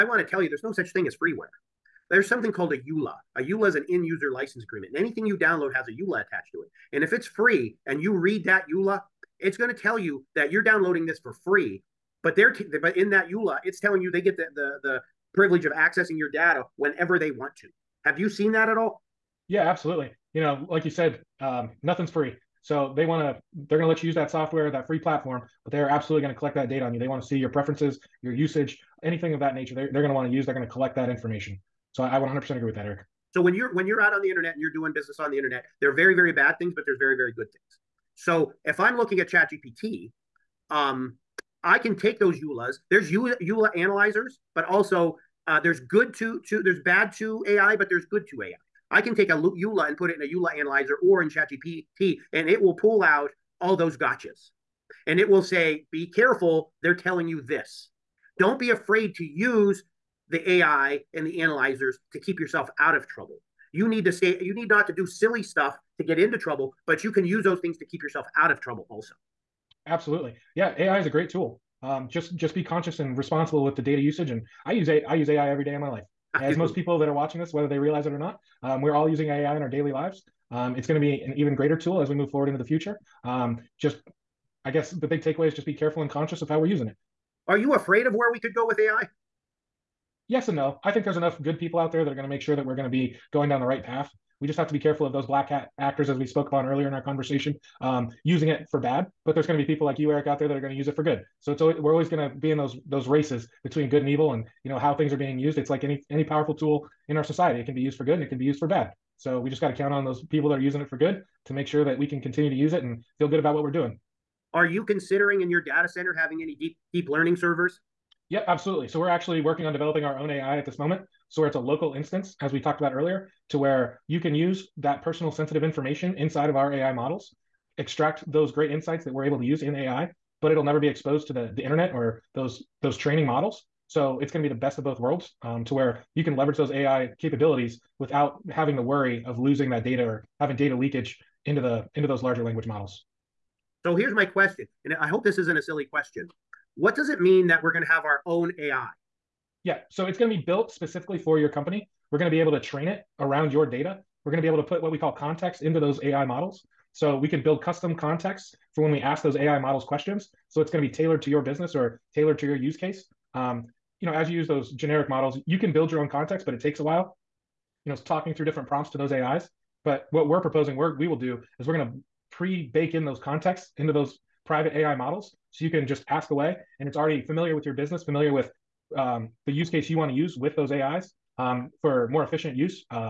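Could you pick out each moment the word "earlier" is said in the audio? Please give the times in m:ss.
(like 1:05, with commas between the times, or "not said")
1:36, 2:02.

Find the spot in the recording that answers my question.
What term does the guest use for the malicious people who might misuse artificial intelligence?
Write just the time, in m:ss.
1:35.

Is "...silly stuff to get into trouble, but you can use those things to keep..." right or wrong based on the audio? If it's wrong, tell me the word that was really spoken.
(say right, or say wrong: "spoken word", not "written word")
right.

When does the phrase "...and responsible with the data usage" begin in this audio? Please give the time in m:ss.
1:12.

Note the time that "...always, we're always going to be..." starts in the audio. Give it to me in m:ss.
1:41.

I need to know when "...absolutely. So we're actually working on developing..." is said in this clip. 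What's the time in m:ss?
1:58.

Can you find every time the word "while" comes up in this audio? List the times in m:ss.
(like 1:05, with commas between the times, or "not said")
2:46.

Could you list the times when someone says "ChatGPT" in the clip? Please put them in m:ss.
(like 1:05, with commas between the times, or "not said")
0:39, 0:51.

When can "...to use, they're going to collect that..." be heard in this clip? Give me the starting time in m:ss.
0:30.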